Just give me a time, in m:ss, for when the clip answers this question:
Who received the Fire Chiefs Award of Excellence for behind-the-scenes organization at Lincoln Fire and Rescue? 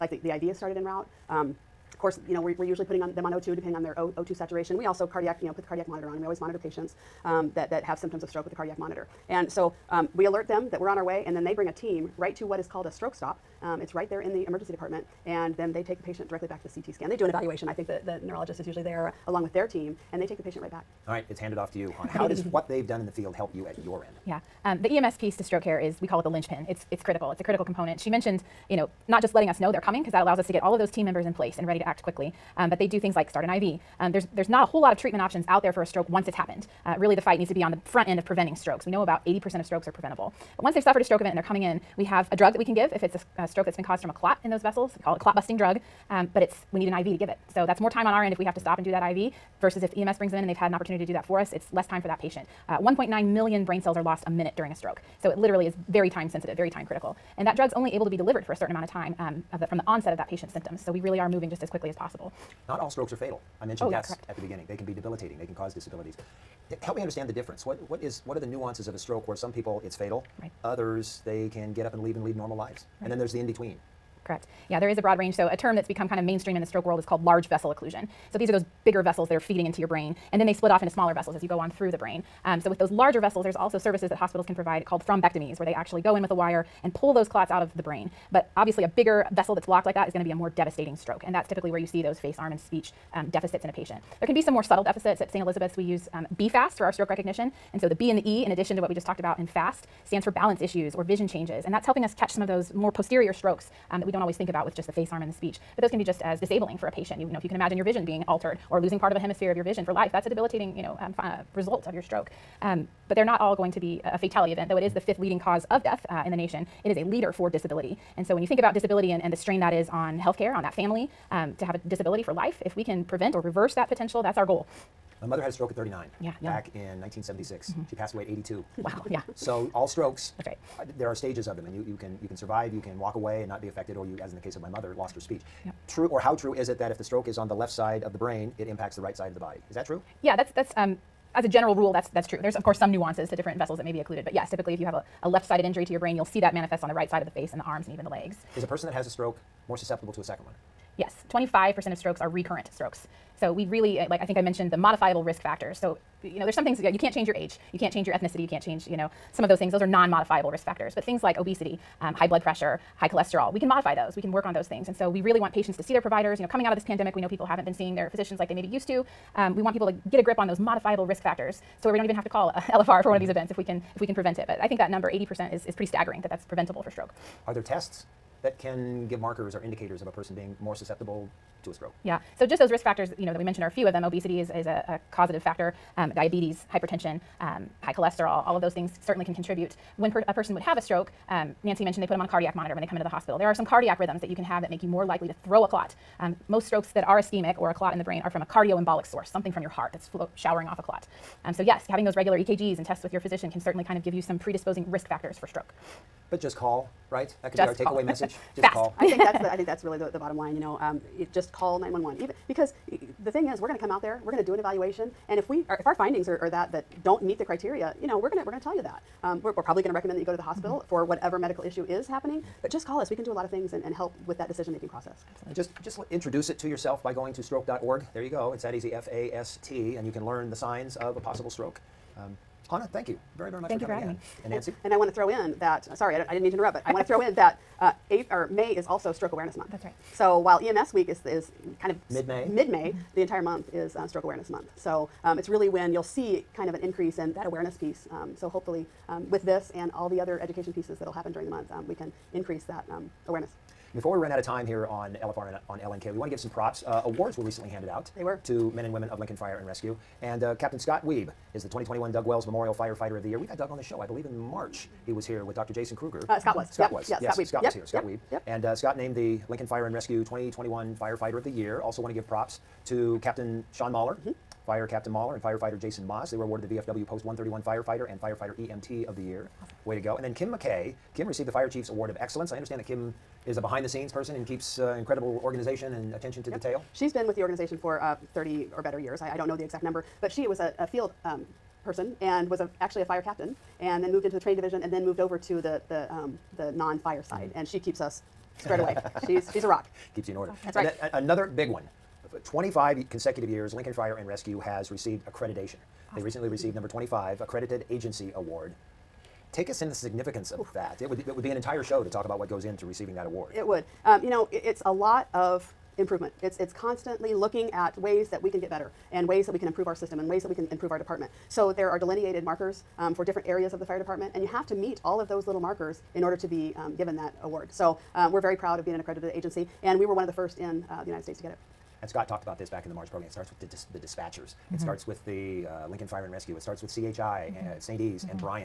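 4:40.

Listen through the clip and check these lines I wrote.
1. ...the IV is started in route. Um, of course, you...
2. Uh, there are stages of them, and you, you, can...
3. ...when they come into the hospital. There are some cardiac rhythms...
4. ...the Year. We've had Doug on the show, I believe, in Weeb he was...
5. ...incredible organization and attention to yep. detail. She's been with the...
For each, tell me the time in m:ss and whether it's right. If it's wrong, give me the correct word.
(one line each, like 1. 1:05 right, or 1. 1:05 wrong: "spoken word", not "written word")
1. 0:00 right
2. 2:10 right
3. 3:12 right
4. 4:23 wrong: "March", not "Weeb"
5. 4:44 right.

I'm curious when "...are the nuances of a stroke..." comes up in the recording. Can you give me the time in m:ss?
1:08.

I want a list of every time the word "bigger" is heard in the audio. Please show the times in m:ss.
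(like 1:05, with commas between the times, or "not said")
1:18, 1:28.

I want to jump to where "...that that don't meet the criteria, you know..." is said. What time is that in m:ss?
3:36.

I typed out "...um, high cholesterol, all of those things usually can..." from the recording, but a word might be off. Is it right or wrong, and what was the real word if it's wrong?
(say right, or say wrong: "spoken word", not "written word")
wrong: "certainly", not "usually".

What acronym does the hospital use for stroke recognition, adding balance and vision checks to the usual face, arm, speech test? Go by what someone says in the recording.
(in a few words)
BFAST.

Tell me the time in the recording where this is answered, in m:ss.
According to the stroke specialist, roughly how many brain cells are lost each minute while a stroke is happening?
0:52.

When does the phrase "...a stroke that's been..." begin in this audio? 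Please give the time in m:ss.
0:43.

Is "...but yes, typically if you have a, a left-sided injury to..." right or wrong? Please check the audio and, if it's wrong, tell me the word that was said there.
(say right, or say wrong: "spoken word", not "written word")
right.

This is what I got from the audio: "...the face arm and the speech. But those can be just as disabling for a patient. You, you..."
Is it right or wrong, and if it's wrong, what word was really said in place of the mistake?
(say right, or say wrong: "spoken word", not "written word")
right.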